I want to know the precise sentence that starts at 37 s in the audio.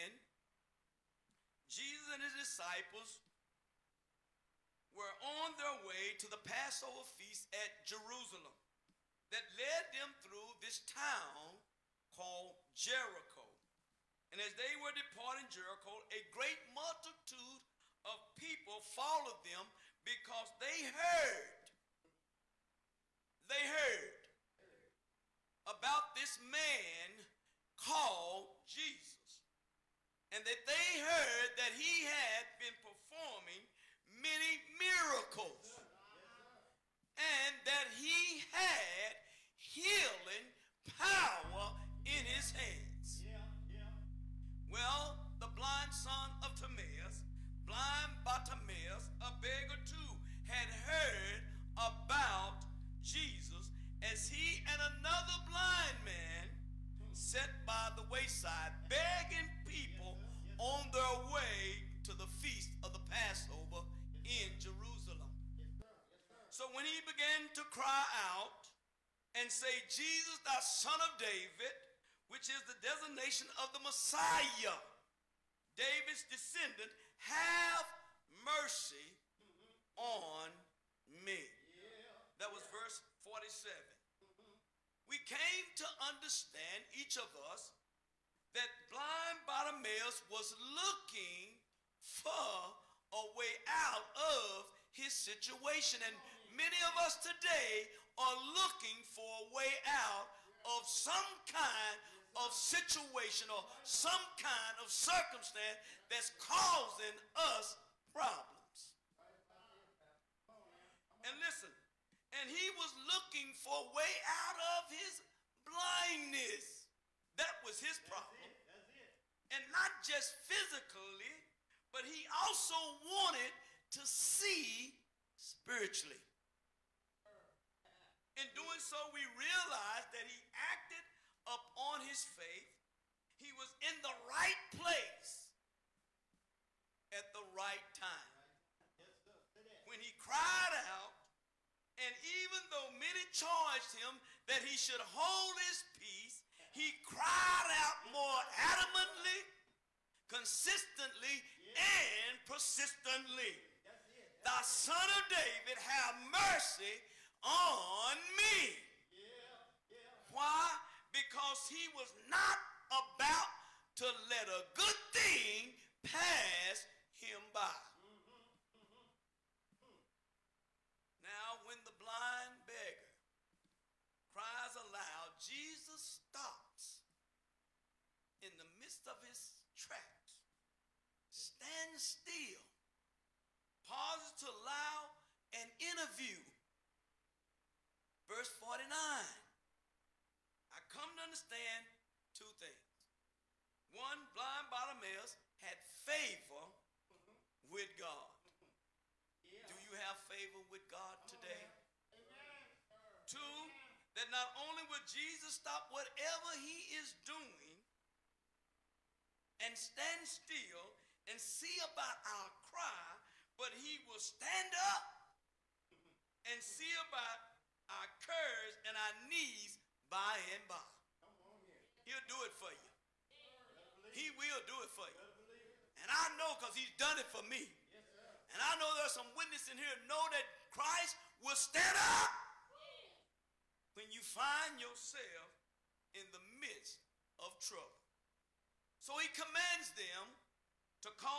And that he had healing power in his hands.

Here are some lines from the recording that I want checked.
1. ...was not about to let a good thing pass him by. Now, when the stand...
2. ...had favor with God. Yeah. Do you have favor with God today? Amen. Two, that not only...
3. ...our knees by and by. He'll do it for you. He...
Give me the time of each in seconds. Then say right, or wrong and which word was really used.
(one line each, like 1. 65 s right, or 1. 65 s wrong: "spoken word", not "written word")
1. 161 s wrong: "blind", not "stand"
2. 195 s right
3. 218 s right.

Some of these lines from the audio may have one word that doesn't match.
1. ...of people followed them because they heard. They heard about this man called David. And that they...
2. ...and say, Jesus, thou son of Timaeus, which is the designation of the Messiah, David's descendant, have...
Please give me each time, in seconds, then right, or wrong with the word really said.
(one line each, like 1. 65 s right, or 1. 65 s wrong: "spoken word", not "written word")
1. 18 s wrong: "Jesus", not "David"
2. 69 s wrong: "David", not "Timaeus".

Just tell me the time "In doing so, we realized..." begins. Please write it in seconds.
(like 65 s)
128 s.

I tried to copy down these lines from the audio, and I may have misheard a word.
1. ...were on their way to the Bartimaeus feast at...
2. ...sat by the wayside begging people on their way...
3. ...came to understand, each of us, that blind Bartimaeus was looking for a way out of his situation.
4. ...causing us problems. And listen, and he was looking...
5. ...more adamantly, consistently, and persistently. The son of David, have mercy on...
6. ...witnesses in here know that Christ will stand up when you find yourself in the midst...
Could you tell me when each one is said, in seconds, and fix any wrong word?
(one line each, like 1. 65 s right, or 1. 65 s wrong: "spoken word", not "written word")
1. 4 s wrong: "Passover", not "Bartimaeus"
2. 57 s right
3. 85 s right
4. 106 s right
5. 148 s right
6. 229 s right.